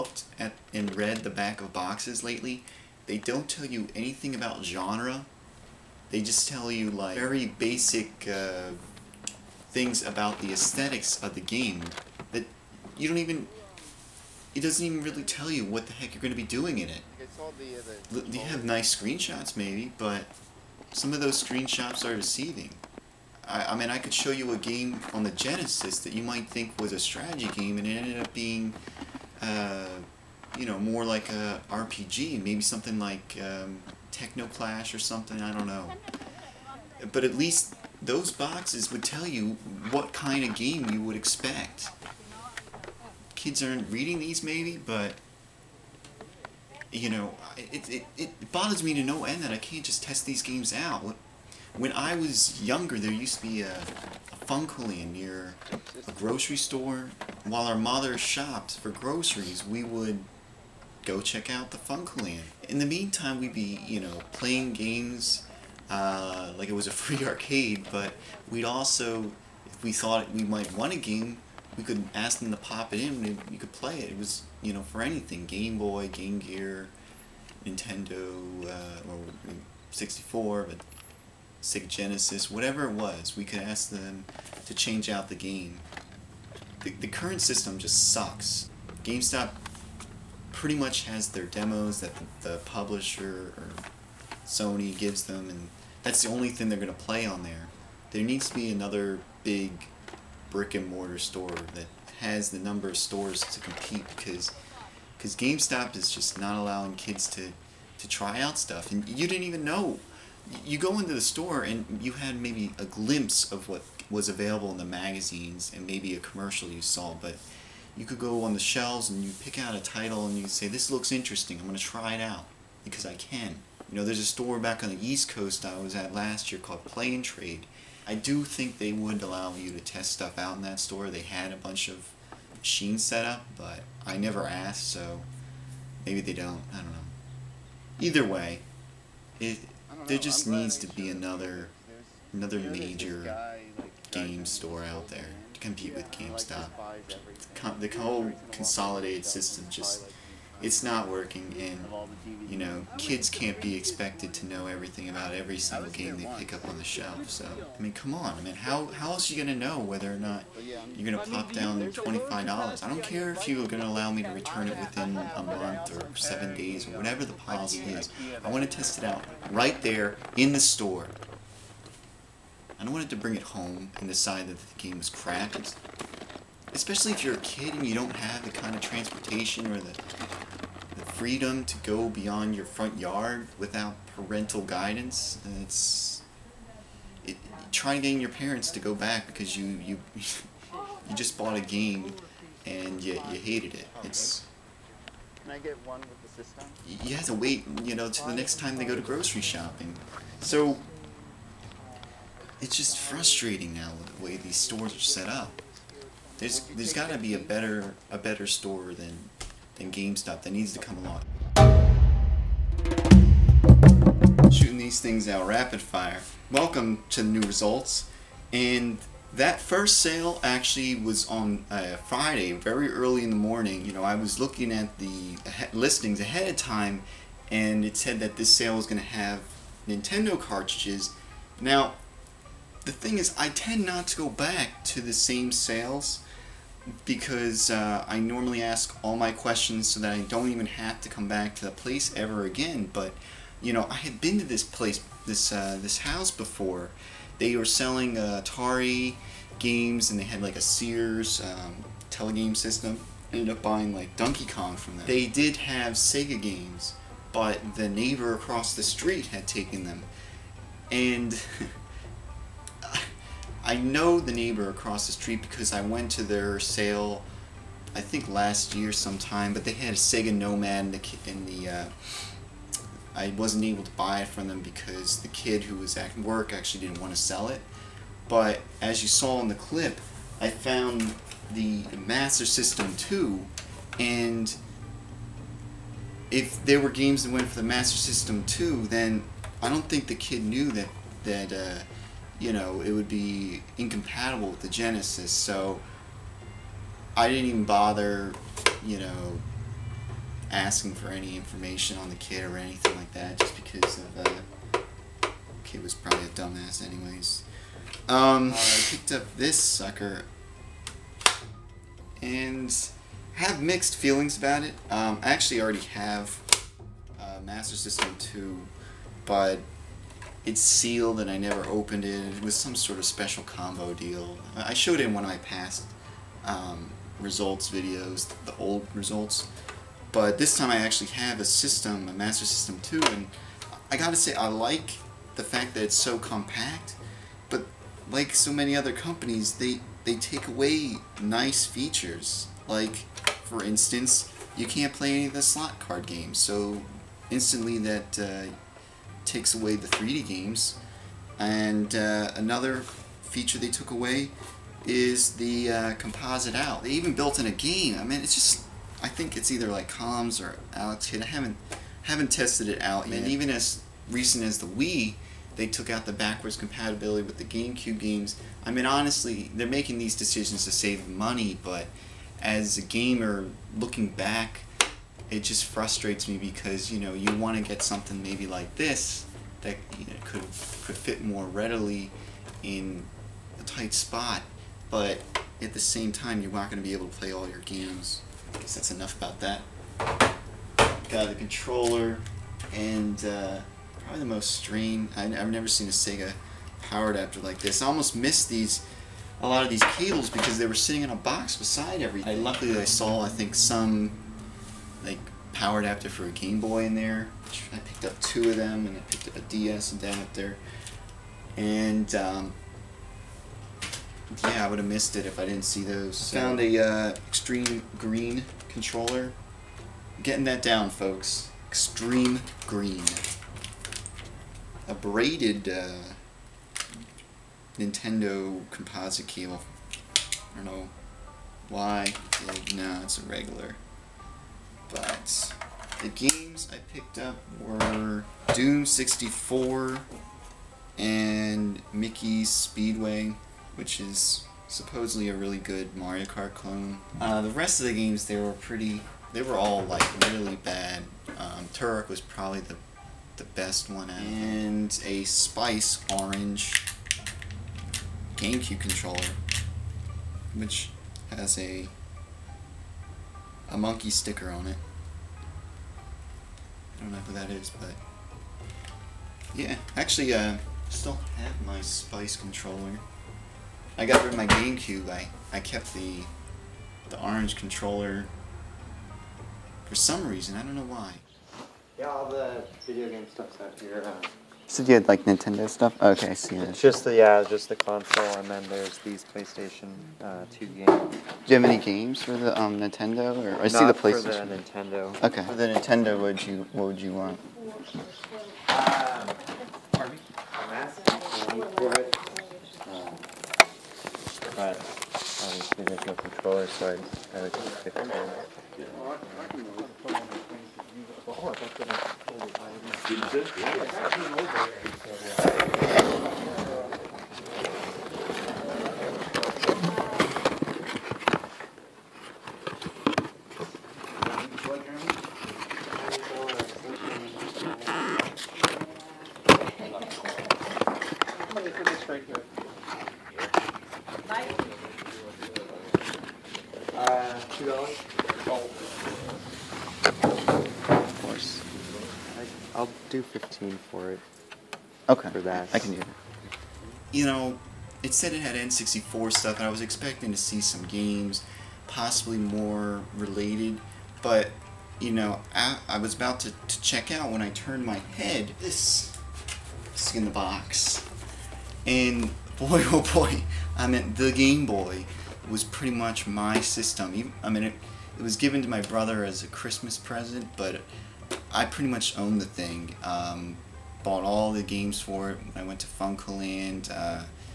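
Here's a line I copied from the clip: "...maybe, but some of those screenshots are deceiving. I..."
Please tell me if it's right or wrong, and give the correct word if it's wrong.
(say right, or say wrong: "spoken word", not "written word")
right.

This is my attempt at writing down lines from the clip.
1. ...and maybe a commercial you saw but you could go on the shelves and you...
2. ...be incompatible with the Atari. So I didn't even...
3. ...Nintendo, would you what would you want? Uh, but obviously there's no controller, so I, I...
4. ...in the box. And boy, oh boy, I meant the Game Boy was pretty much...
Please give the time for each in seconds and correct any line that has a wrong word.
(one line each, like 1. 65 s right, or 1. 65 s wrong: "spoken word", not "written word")
1. 115 s right
2. 293 s wrong: "Genesis", not "Atari"
3. 495 s right
4. 560 s right.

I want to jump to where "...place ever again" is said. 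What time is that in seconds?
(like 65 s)
241 s.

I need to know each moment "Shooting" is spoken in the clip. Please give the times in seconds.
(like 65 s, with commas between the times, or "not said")
214 s.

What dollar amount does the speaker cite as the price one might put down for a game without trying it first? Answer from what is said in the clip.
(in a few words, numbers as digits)
$25.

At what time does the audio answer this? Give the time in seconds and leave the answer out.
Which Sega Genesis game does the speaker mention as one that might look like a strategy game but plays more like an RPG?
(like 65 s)
34 s.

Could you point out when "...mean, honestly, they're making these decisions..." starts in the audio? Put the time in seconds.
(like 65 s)
368 s.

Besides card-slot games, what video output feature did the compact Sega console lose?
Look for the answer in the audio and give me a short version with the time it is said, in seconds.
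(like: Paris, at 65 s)
Composite out, at 355 s.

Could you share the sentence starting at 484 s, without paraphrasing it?
Uh so you had like Nintendo stuff?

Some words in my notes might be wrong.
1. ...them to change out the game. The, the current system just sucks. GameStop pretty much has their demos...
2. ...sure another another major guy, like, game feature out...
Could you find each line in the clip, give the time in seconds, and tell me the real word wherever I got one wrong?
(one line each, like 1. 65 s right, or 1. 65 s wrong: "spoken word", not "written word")
1. 83 s right
2. 141 s wrong: "store", not "feature".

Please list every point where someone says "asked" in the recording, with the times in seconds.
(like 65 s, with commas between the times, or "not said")
134 s.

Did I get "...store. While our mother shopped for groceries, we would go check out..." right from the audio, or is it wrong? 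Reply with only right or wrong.
right.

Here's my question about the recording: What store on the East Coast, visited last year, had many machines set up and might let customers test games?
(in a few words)
Play N Trade.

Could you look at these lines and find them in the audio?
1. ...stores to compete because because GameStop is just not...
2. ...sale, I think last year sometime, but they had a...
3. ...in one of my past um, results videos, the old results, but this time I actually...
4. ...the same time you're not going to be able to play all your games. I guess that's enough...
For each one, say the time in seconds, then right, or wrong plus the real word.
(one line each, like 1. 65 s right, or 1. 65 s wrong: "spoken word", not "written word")
1. 102 s right
2. 266 s right
3. 325 s right
4. 385 s right.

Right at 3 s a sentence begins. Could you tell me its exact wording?
They don't tell you anything about genre.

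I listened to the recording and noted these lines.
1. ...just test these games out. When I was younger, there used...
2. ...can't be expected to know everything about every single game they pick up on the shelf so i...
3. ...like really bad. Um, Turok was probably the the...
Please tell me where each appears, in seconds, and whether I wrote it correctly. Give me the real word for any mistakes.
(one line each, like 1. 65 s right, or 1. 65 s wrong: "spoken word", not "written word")
1. 49 s right
2. 153 s right
3. 449 s right.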